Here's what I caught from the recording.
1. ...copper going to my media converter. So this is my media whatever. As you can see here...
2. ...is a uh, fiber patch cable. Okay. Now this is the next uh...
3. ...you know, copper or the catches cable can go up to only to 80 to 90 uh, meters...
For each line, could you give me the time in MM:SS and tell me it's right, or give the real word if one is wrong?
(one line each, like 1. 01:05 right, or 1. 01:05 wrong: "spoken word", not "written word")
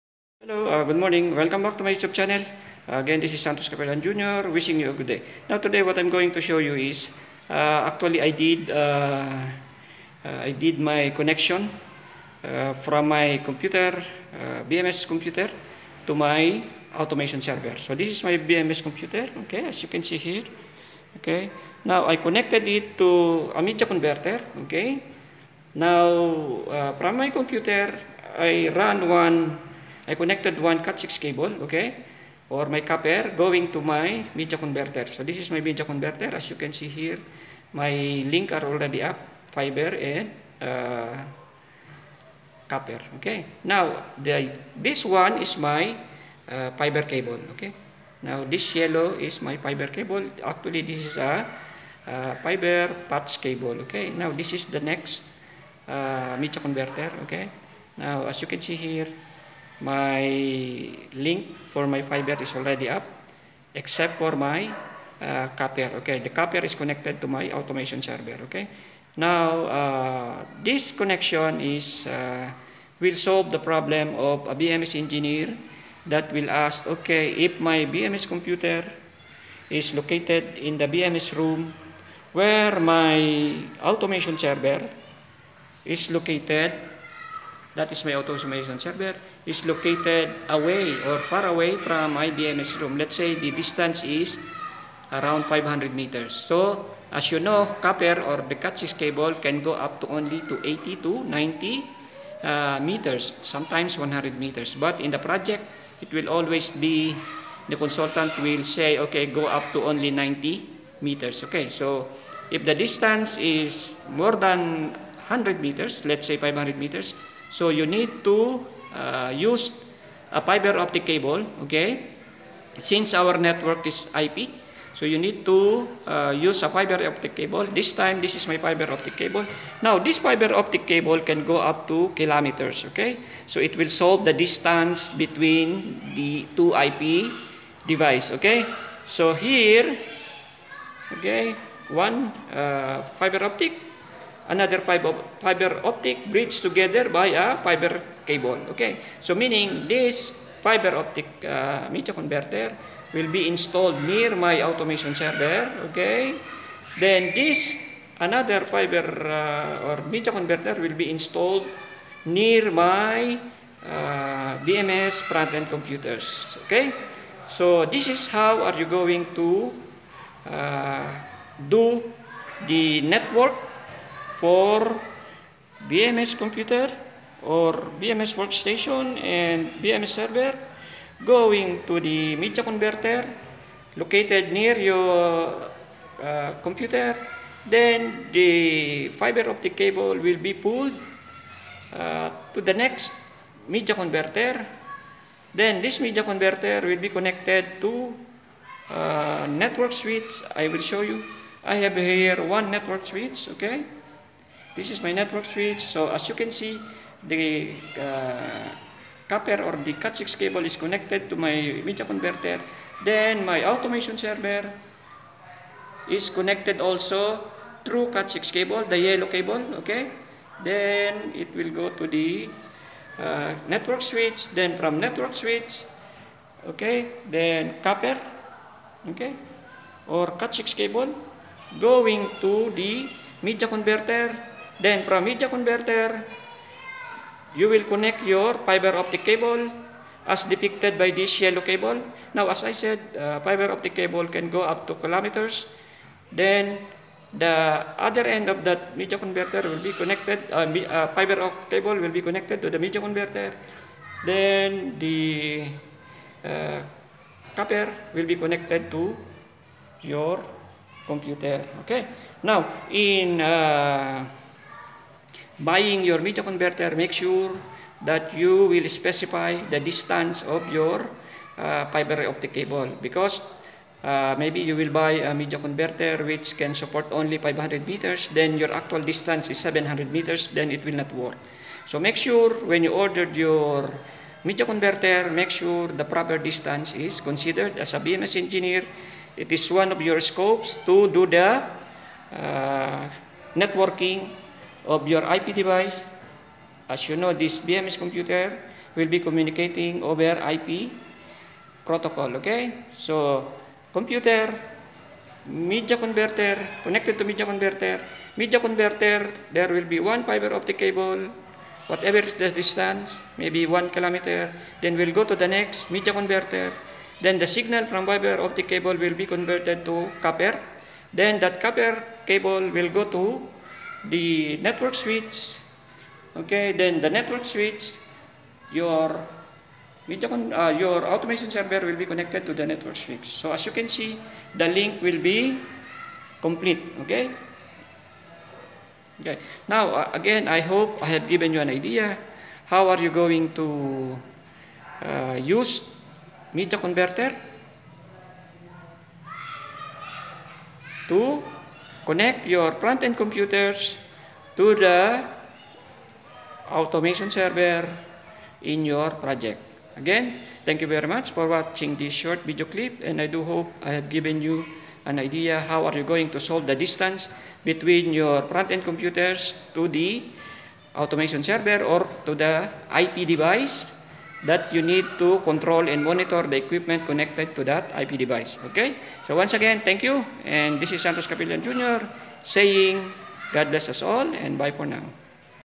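1. 00:32 wrong: "converter", not "whatever"
2. 00:51 right
3. 01:37 right.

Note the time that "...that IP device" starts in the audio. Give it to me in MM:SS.
06:17.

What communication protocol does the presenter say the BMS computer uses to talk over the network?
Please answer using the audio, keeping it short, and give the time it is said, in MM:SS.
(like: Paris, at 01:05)
IP protocol, at 05:00.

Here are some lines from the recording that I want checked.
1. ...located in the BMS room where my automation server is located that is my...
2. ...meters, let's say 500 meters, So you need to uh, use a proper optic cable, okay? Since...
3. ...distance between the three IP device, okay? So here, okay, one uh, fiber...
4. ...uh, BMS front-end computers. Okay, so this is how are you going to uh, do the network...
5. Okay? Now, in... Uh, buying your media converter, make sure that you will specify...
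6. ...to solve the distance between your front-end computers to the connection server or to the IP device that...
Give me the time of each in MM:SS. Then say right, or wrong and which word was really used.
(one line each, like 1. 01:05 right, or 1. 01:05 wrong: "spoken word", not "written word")
1. 01:19 right
2. 01:55 wrong: "fiber", not "proper"
3. 02:14 wrong: "two", not "three"
4. 02:43 right
5. 04:21 right
6. 06:06 wrong: "automation", not "connection".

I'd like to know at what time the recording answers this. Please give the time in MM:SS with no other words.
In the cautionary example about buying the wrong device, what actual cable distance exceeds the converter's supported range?
04:39.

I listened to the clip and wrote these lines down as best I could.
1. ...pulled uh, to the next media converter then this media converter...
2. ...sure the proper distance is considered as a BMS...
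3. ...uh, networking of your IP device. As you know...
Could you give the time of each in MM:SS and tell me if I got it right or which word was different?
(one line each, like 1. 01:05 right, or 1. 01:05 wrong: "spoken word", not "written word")
1. 03:10 right
2. 04:45 right
3. 04:52 right.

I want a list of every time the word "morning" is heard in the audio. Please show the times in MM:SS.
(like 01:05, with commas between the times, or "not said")
00:00.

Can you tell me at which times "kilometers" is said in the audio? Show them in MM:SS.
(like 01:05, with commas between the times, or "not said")
02:12, 04:04, 05:13.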